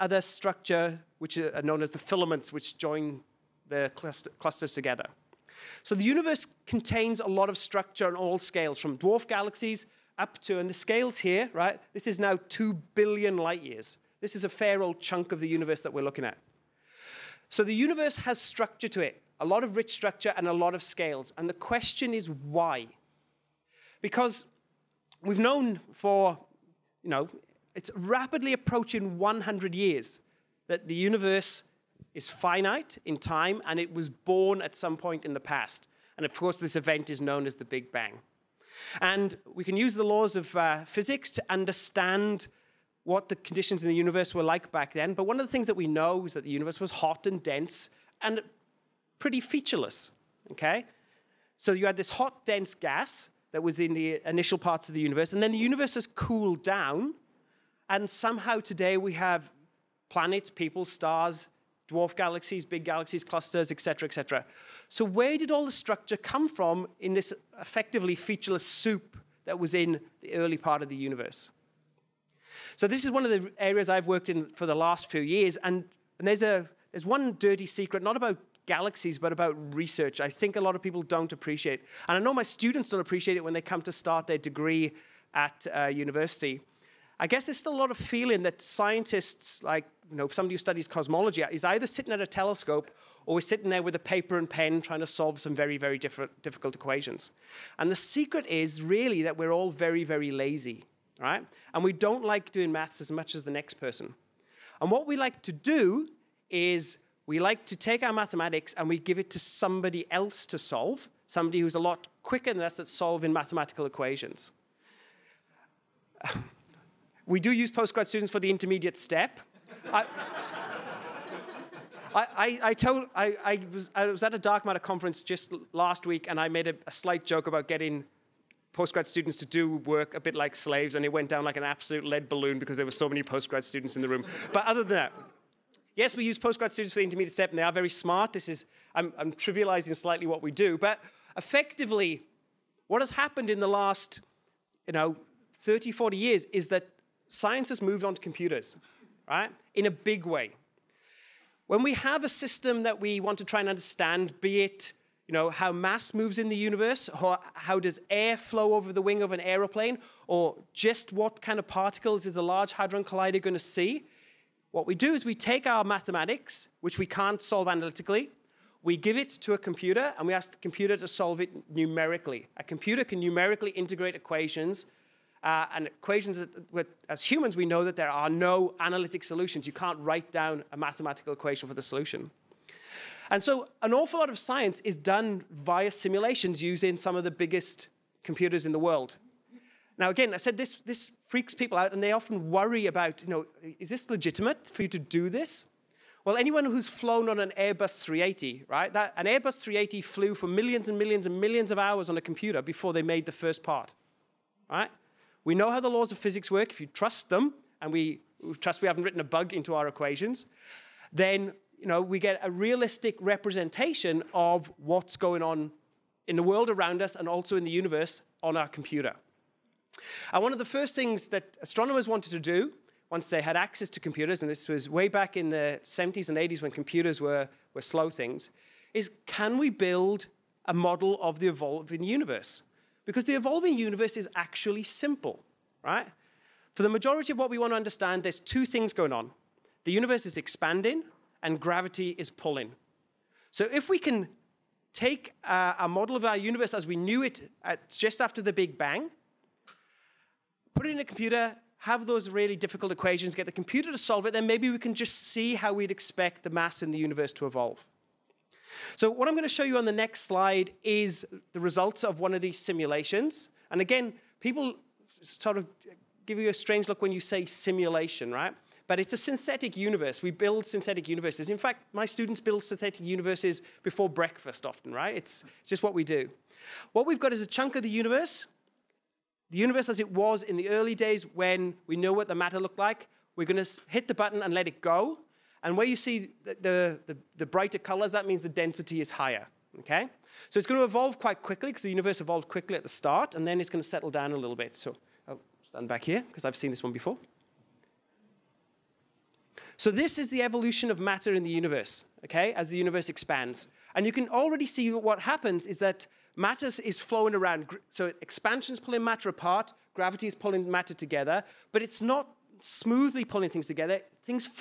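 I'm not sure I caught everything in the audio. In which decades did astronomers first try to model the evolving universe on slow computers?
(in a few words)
70s and 80s.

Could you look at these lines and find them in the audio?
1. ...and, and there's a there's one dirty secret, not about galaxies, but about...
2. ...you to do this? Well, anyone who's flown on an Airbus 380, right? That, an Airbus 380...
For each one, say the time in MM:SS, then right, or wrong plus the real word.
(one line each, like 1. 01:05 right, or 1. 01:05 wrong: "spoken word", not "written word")
1. 01:15 right
2. 03:14 right.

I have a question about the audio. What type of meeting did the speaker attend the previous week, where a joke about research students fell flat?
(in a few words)
dark matter conference.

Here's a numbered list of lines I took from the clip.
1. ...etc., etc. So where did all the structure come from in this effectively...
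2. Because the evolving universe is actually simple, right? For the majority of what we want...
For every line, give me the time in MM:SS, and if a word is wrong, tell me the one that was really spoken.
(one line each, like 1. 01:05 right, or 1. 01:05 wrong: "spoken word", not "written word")
1. 01:03 right
2. 03:53 right.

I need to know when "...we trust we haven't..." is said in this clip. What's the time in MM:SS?
03:27.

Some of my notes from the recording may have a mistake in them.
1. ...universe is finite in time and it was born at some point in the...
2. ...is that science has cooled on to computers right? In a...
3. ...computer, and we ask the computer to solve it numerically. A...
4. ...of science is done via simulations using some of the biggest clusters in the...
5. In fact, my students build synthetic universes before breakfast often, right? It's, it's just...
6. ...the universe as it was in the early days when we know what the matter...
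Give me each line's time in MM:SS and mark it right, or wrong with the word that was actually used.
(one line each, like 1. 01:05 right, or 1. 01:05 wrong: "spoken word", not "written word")
1. 00:30 right
2. 02:26 wrong: "moved", not "cooled"
3. 02:49 right
4. 03:04 wrong: "computers", not "clusters"
5. 04:31 right
6. 04:39 right.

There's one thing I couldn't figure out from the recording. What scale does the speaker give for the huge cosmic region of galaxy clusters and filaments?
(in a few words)
2 billion light years.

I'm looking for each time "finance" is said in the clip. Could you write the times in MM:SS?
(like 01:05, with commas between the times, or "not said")
not said.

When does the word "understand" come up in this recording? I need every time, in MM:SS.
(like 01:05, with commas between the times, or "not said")
00:41, 02:33, 03:57.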